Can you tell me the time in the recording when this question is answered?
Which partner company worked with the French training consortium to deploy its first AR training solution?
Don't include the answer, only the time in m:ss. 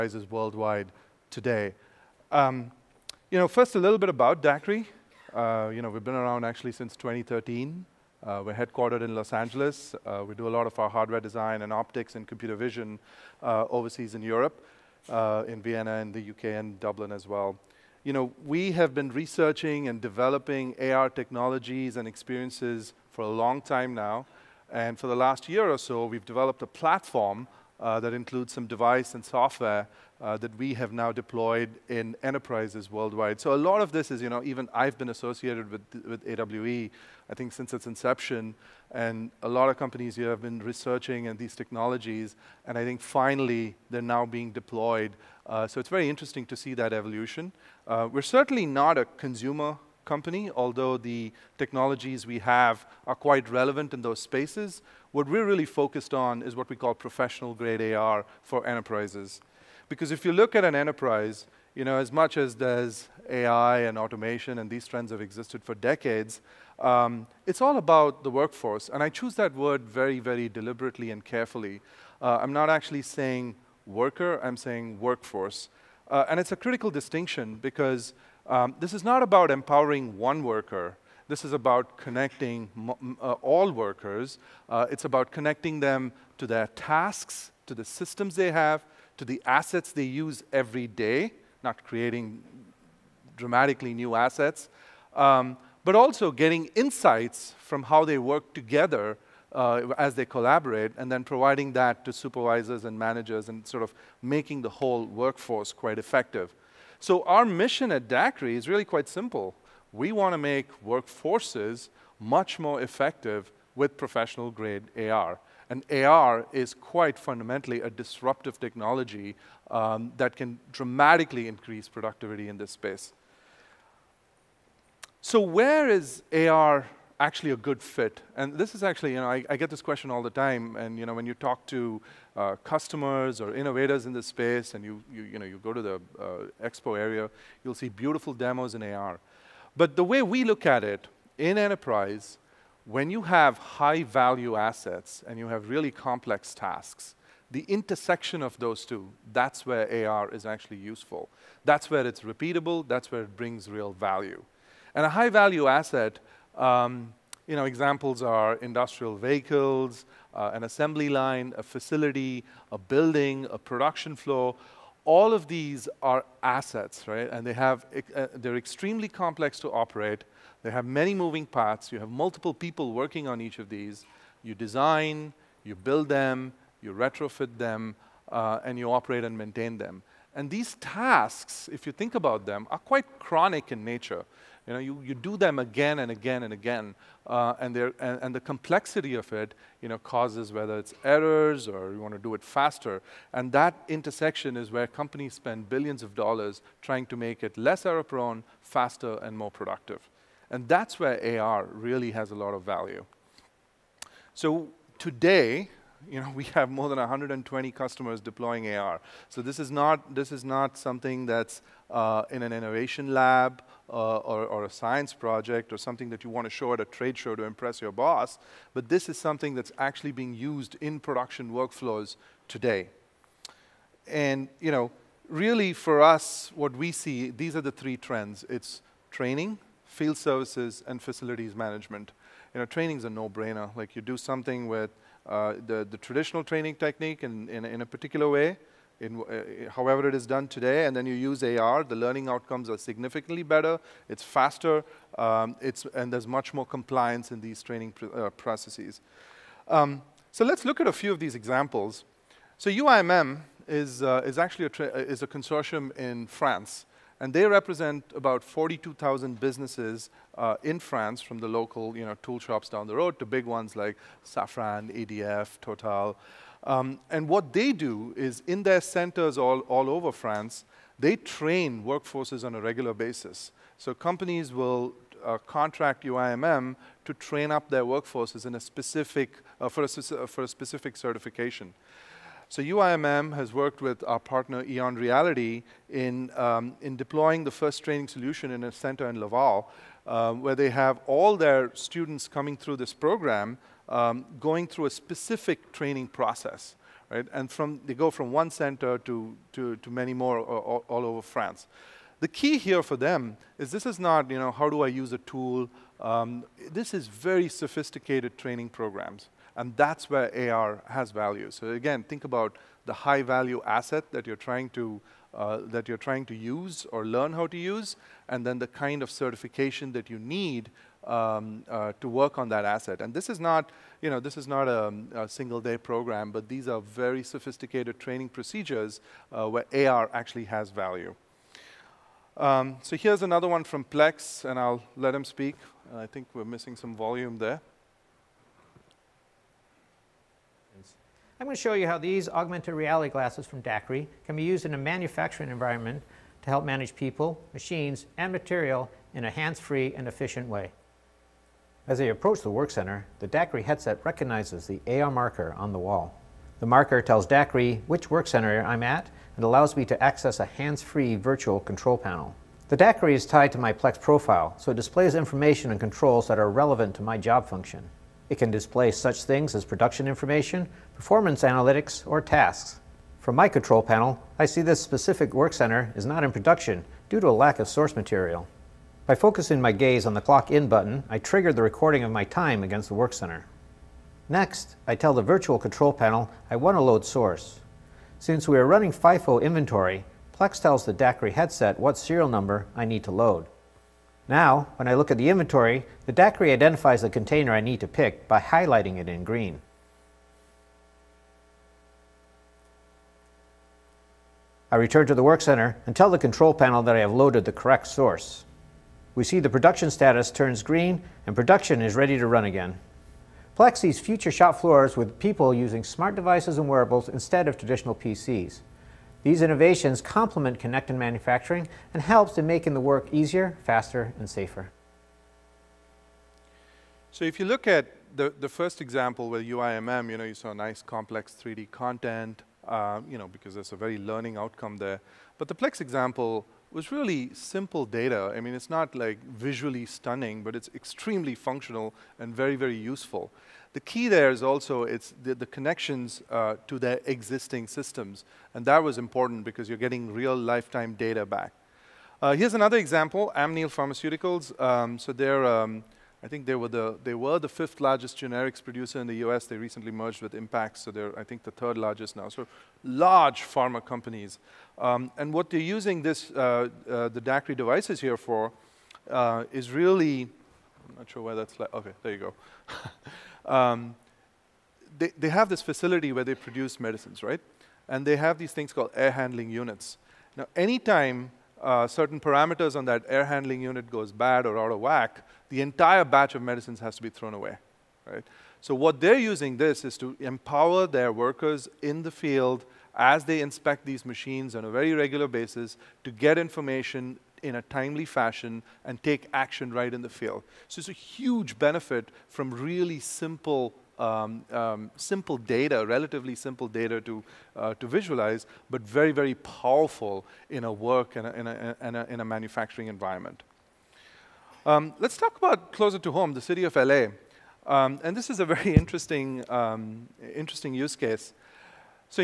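4:44.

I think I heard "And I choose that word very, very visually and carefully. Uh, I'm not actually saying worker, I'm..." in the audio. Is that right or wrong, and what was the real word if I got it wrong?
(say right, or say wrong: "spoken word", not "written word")
wrong: "deliberately", not "visually".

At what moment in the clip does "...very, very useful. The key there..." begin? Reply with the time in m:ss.
7:22.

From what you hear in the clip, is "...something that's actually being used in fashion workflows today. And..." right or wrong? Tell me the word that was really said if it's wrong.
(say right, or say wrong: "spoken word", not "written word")
wrong: "production", not "fashion".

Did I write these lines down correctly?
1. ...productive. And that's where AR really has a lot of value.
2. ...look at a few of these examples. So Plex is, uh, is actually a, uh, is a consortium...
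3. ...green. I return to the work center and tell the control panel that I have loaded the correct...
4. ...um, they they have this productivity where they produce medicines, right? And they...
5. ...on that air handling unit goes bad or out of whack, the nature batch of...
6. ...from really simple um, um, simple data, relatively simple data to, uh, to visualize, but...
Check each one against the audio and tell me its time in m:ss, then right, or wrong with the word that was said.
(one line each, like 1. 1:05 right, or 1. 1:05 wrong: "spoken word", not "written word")
1. 3:19 right
2. 4:10 wrong: "UIMM", not "Plex"
3. 6:39 right
4. 7:53 wrong: "facility", not "productivity"
5. 8:02 wrong: "entire", not "nature"
6. 8:22 right.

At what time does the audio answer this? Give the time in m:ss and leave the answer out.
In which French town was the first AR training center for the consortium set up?
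4:49.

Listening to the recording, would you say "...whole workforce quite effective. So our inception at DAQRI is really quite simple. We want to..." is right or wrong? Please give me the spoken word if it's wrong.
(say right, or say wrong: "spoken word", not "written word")
wrong: "mission", not "inception".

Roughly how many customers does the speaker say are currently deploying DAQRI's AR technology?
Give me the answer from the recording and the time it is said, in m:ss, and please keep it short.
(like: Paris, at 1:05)
more than 120, at 3:26.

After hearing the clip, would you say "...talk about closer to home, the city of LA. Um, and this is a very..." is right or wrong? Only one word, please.
right.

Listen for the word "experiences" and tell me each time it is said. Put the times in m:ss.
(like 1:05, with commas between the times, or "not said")
0:22.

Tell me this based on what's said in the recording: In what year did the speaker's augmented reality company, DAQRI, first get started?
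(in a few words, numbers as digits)
2013.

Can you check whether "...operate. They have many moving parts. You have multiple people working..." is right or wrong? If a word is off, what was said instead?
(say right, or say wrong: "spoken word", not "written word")
right.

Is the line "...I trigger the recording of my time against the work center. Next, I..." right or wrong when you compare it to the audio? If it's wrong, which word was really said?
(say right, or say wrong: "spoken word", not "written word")
right.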